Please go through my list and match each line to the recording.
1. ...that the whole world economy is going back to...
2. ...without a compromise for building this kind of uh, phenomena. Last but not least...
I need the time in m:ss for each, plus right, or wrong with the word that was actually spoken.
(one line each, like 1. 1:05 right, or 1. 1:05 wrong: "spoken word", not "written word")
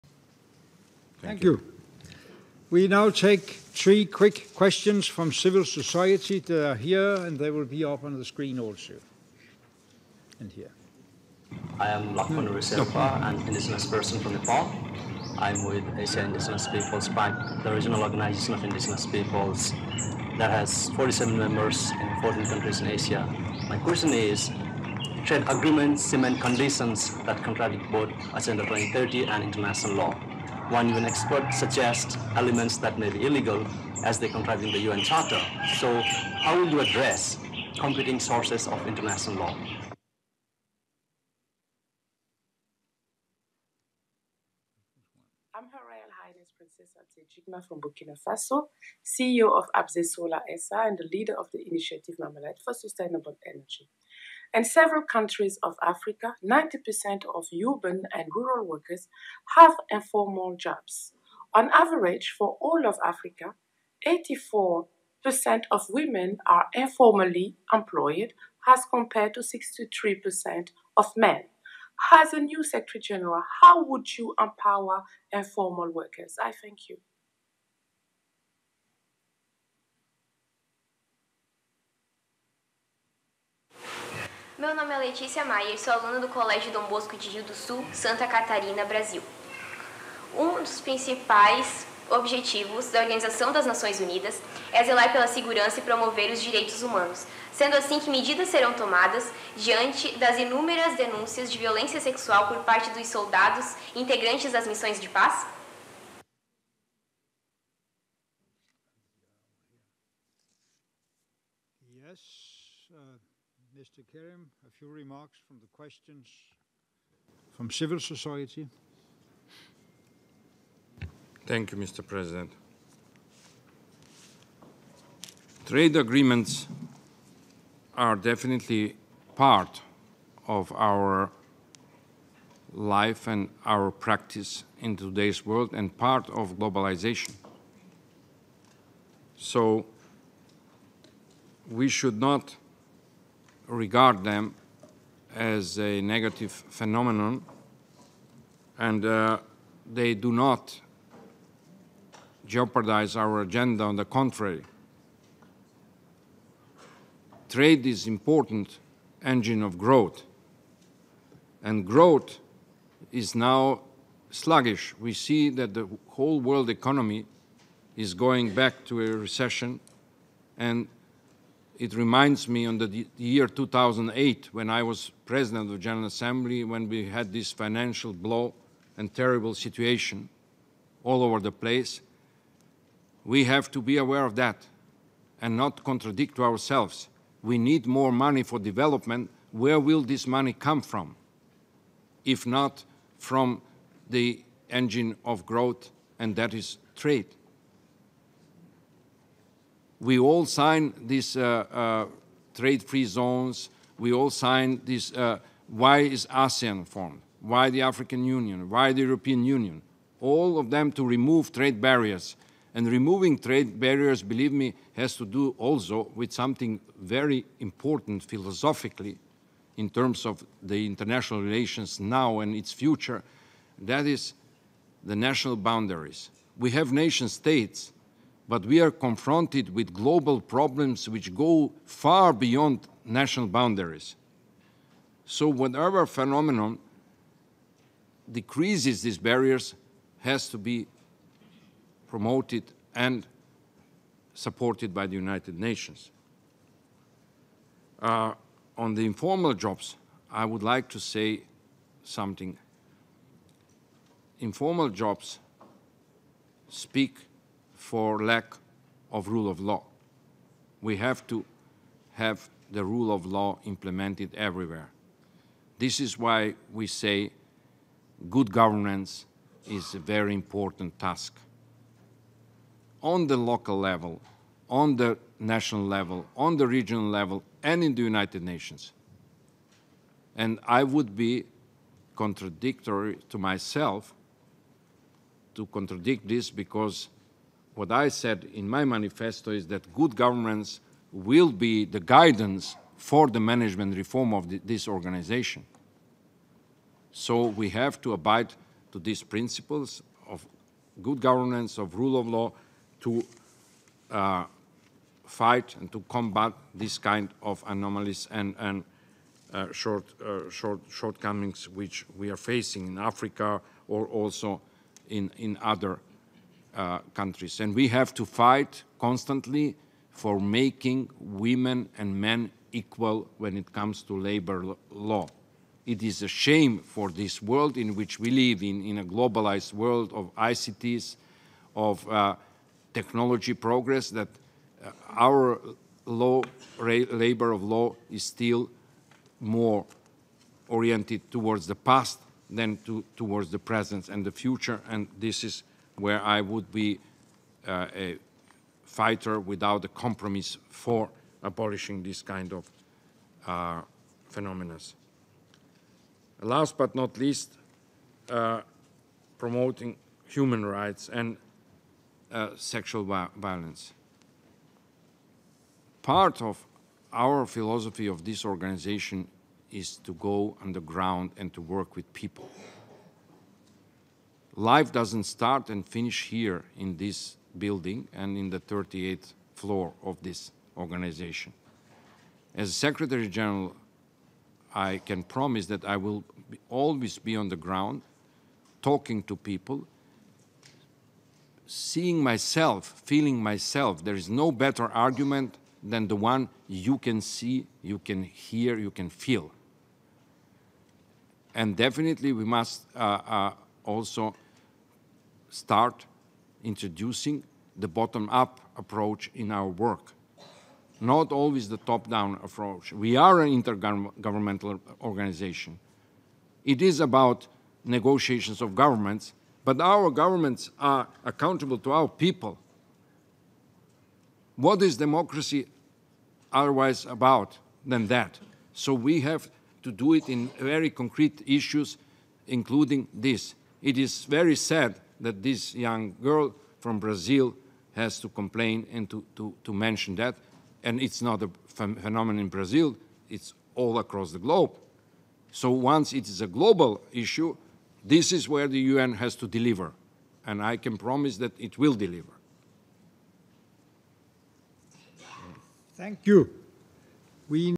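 1. 2:45 right
2. 5:49 wrong: "abolishing", not "building".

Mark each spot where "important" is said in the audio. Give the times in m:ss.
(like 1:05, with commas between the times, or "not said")
2:38, 3:37, 4:30.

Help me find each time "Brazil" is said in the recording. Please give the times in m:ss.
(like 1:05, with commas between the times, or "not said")
7:16, 7:22.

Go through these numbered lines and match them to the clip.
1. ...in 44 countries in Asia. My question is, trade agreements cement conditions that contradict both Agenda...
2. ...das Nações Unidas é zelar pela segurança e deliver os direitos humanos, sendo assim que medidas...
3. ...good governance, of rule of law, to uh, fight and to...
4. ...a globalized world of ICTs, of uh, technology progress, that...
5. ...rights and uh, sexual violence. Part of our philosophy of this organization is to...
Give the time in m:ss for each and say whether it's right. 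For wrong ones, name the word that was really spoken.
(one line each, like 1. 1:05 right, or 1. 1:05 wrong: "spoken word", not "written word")
1. 0:21 wrong: "14", not "44"
2. 1:33 wrong: "promover", not "deliver"
3. 5:01 right
4. 5:28 right
5. 6:00 right.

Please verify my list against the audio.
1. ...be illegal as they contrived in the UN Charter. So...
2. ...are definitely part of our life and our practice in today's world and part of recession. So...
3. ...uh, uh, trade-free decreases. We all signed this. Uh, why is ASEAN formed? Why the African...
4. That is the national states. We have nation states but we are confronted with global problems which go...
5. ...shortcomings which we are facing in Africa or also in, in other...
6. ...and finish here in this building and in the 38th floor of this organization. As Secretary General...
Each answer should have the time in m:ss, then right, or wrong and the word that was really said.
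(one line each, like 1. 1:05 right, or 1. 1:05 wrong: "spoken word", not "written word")
1. 0:33 right
2. 2:07 wrong: "globalization", not "recession"
3. 3:21 wrong: "zones", not "decreases"
4. 3:43 wrong: "boundaries", not "states"
5. 5:10 right
6. 6:15 right.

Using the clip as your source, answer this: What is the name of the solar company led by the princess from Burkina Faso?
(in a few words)
Abze Solar SA.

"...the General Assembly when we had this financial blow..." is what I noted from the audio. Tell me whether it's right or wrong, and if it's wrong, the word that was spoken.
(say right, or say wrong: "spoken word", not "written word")
right.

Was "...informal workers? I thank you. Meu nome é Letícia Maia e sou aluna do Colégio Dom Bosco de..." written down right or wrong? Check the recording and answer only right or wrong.
right.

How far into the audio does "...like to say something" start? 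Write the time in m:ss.
4:10.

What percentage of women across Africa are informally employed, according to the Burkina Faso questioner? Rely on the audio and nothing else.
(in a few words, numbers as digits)
84%.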